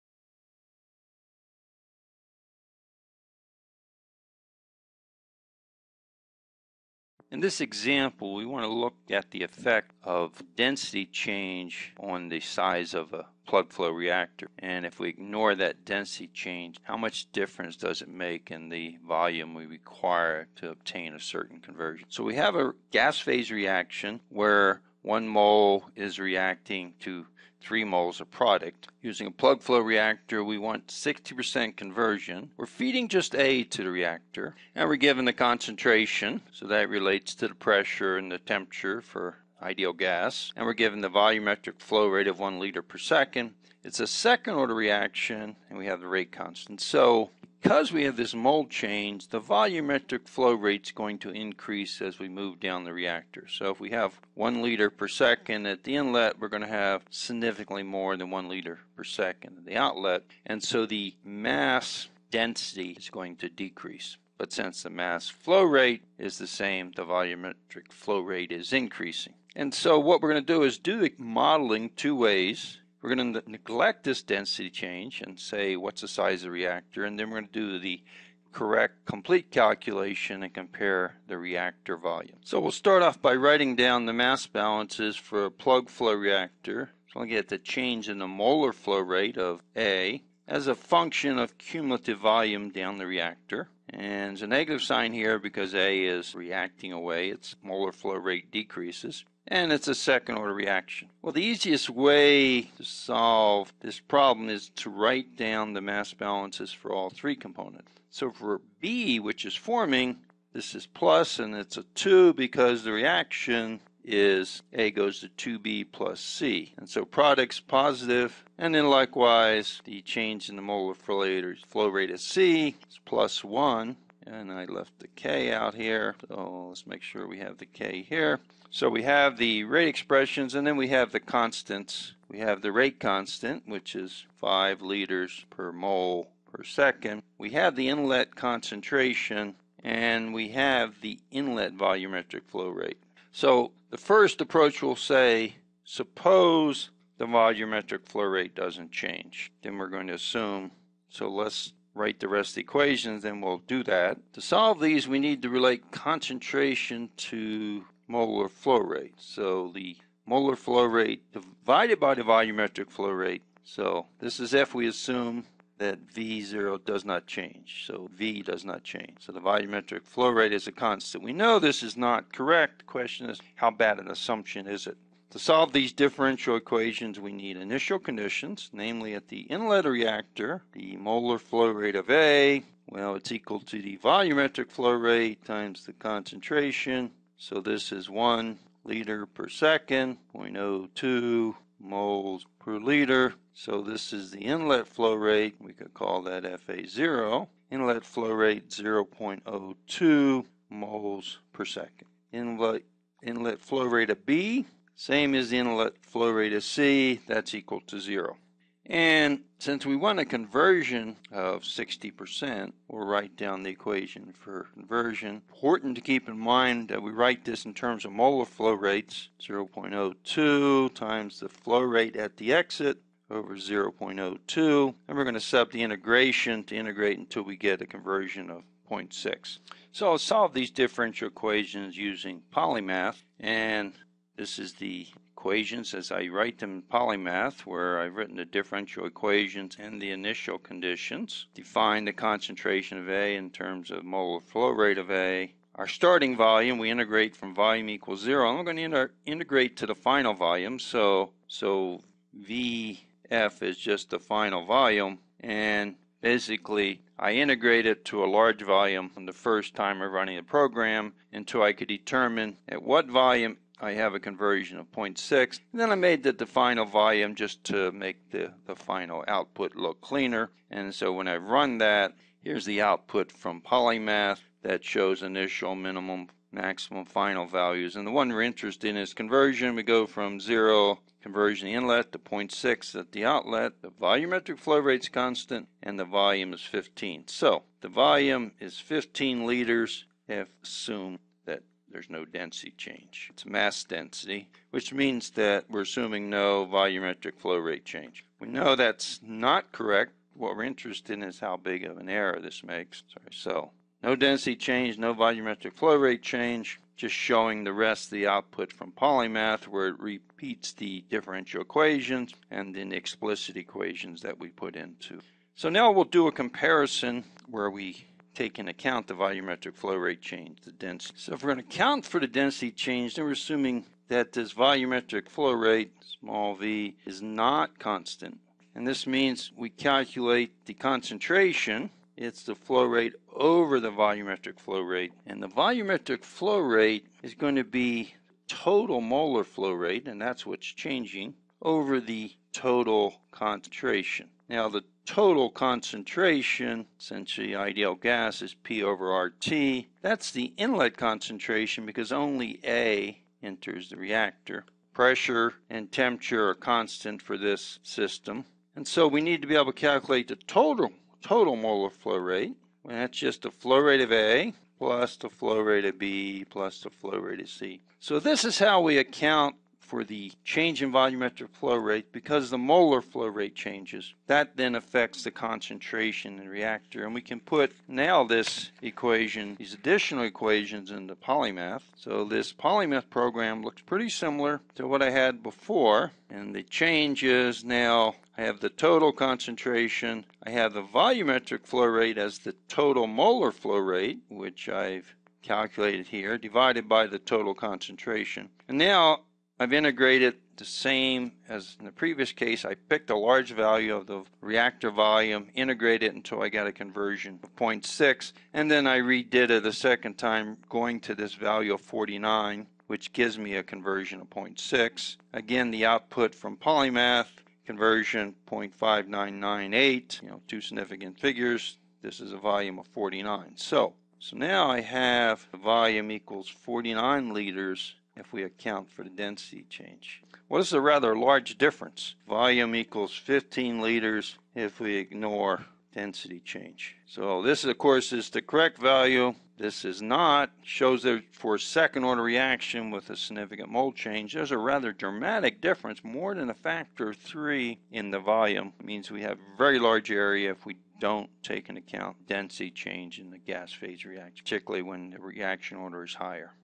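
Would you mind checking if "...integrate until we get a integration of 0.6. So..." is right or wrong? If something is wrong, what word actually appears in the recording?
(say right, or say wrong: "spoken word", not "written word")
wrong: "conversion", not "integration".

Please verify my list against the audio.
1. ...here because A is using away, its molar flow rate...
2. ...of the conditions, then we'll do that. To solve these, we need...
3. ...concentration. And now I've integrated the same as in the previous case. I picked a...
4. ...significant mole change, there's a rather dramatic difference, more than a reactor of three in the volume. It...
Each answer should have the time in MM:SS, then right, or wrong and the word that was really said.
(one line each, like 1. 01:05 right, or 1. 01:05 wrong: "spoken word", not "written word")
1. 01:35 wrong: "reacting", not "using"
2. 02:32 wrong: "equations", not "conditions"
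3. 06:37 right
4. 07:23 wrong: "factor", not "reactor".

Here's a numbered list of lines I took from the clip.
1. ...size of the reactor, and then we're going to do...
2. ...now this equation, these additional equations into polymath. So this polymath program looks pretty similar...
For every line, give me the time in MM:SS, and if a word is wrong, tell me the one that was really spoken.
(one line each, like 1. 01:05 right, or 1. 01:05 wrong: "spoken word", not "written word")
1. 01:16 right
2. 06:17 right.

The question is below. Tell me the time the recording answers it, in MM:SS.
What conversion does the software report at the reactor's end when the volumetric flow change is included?
06:58.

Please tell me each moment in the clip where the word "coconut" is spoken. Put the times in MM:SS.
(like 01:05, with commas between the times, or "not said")
not said.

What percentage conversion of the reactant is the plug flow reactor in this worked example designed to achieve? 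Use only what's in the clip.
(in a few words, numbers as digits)
60%.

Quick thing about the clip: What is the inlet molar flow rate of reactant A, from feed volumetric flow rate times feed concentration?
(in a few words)
0.02 moles per second.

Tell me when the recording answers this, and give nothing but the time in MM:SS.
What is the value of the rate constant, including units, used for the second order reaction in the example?
02:14.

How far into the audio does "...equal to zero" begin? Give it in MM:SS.
03:27.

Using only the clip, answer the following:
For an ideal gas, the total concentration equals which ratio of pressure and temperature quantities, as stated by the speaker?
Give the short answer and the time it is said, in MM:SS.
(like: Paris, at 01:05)
P over RT, at 05:48.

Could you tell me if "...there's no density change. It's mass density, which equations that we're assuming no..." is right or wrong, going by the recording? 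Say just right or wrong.
wrong.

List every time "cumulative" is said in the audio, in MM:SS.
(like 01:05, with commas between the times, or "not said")
01:31.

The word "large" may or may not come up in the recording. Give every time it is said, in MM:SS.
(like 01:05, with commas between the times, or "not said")
04:18, 06:43, 07:11, 07:29.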